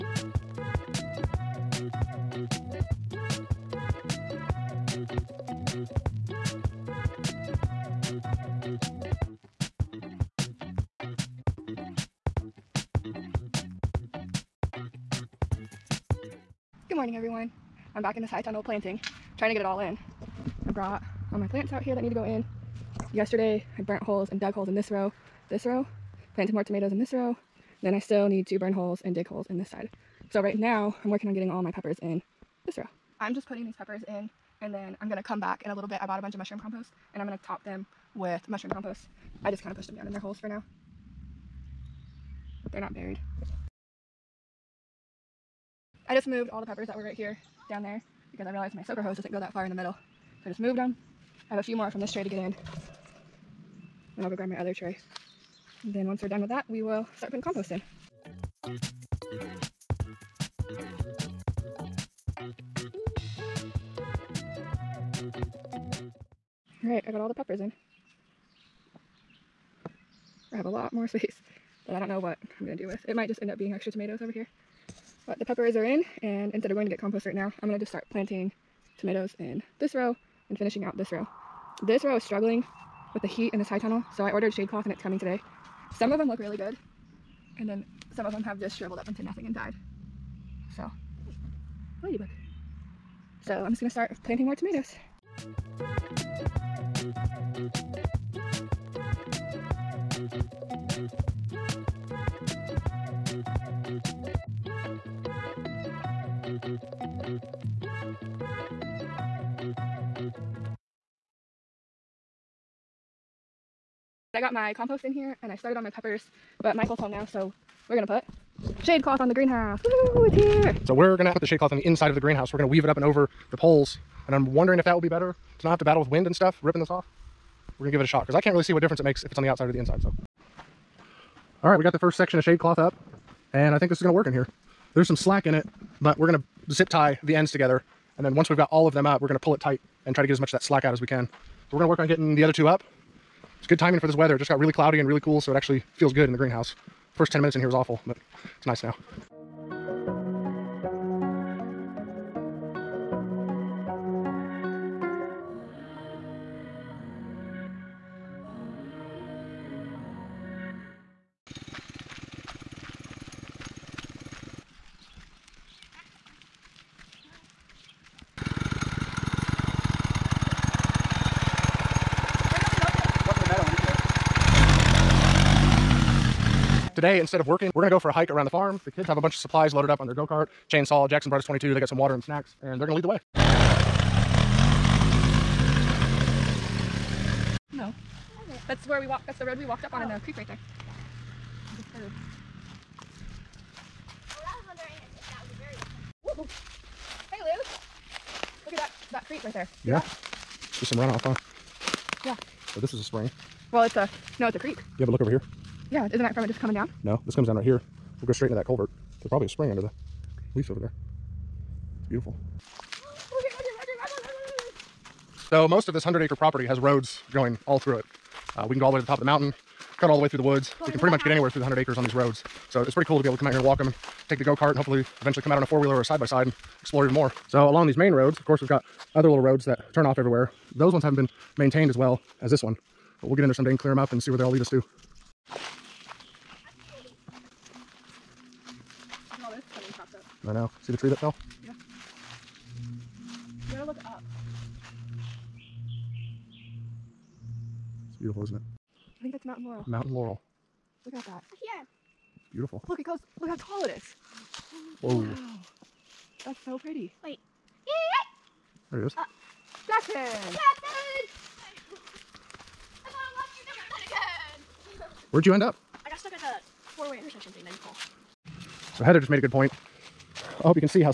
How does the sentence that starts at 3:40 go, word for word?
Go we can pretty much house.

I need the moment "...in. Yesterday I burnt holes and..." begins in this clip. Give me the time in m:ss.
0:22.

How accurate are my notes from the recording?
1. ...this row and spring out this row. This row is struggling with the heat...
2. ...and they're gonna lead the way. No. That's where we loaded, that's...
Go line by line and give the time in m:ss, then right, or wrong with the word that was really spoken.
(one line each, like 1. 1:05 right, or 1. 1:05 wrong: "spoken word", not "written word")
1. 1:19 wrong: "finishing", not "spring"
2. 3:02 wrong: "walked", not "loaded".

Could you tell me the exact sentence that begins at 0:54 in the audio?
Then I'll go grab my other tray.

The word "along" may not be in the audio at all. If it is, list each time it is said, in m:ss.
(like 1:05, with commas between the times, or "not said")
3:47.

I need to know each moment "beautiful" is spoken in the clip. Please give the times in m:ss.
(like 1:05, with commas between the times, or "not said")
3:32, 4:08, 4:12.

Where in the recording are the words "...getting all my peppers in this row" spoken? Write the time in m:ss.
0:31.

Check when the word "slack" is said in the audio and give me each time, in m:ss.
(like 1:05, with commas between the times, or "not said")
2:15, 2:20.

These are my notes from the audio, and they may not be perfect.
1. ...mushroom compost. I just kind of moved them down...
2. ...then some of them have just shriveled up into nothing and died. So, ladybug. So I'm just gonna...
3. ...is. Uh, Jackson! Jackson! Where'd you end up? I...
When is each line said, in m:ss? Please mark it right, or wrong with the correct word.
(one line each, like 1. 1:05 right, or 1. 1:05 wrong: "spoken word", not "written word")
1. 0:38 wrong: "pushed", not "moved"
2. 1:27 right
3. 4:19 right.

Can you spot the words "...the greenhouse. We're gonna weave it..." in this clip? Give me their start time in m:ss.
2:02.